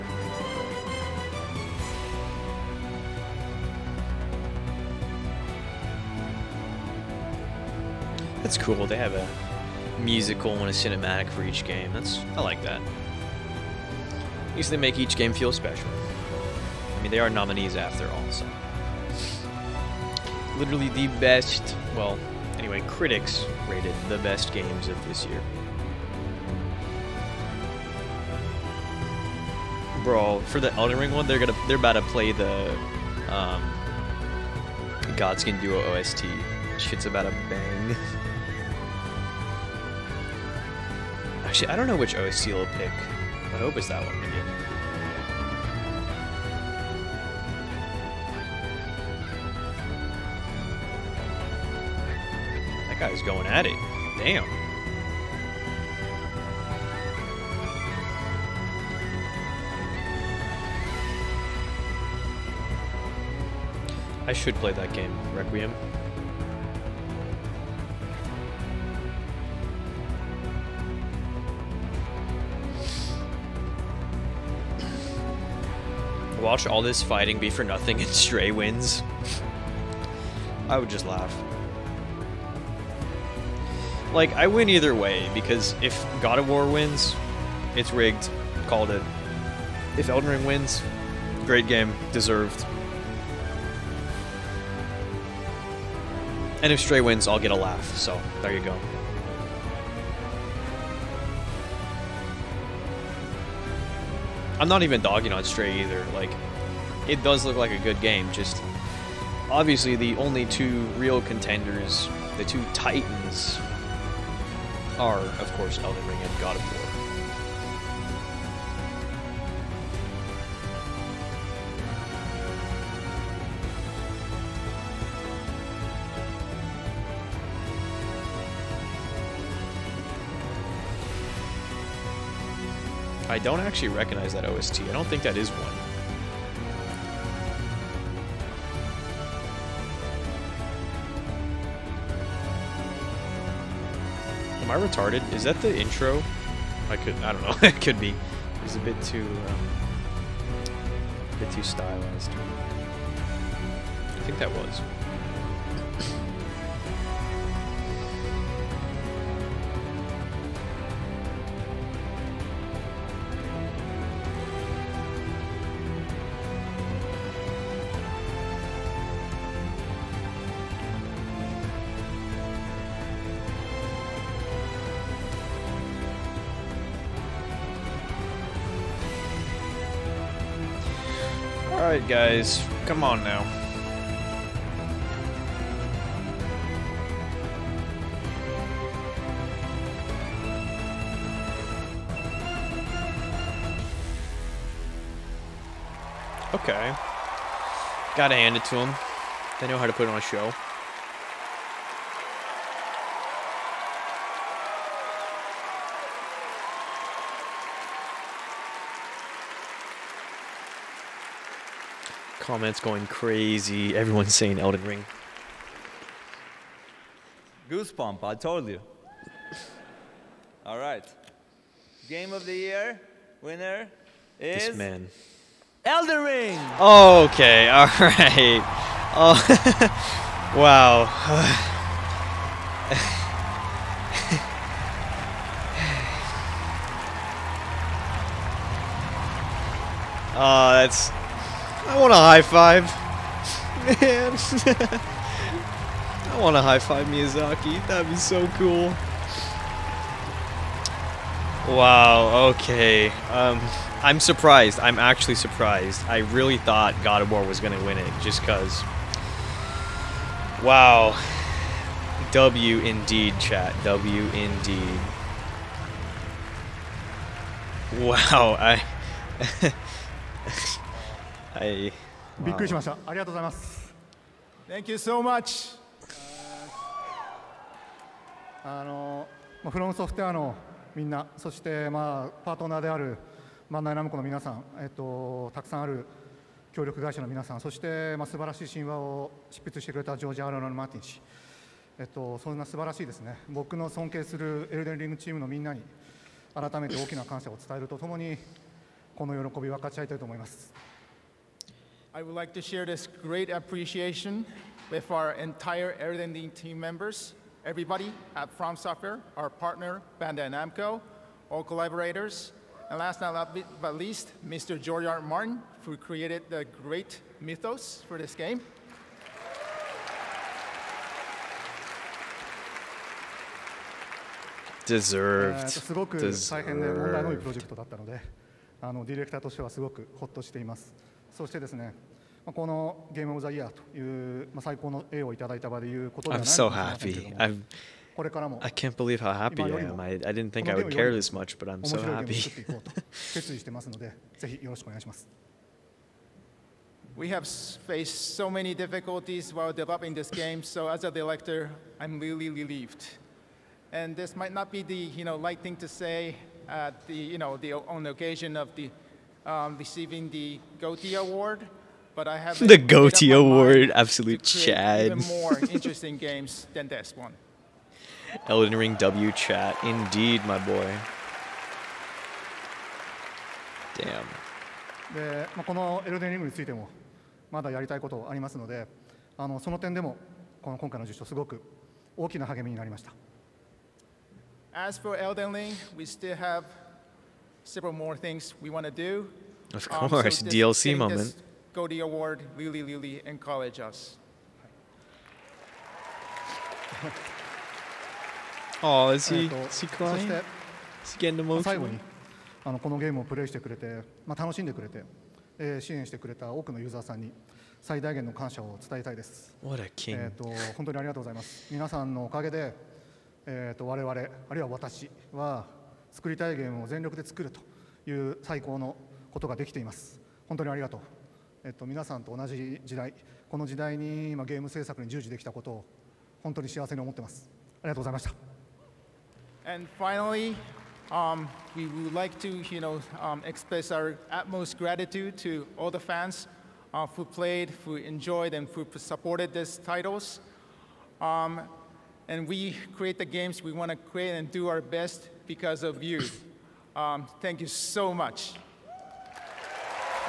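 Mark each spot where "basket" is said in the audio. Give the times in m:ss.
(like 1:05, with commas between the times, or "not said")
not said.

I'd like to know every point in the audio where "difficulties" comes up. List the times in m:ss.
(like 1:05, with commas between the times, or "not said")
5:48.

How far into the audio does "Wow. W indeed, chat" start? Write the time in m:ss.
4:20.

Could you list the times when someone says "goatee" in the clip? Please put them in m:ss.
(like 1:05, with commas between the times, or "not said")
6:02.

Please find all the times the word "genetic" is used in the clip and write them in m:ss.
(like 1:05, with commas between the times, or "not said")
not said.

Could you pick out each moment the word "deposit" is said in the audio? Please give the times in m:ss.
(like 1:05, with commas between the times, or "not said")
not said.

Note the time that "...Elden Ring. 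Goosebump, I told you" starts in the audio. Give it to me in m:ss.
3:34.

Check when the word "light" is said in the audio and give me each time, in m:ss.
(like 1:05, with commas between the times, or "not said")
5:55.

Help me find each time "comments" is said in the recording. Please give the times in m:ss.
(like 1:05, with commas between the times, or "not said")
3:32.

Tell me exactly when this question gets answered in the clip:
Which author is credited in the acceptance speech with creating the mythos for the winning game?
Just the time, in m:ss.
5:14.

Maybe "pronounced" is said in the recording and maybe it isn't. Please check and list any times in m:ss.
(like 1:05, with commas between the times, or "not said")
not said.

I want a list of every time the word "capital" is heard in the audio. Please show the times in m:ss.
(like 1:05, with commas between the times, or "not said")
not said.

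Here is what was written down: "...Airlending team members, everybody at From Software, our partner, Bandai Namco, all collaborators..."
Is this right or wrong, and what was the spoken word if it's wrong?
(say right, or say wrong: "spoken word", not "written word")
right.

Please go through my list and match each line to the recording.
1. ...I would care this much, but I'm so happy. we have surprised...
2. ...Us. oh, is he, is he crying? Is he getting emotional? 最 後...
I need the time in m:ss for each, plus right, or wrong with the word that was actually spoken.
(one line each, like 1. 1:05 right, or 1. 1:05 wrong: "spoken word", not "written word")
1. 5:40 wrong: "faced", not "surprised"
2. 6:33 right.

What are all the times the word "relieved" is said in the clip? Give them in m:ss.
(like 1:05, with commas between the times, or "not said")
5:52.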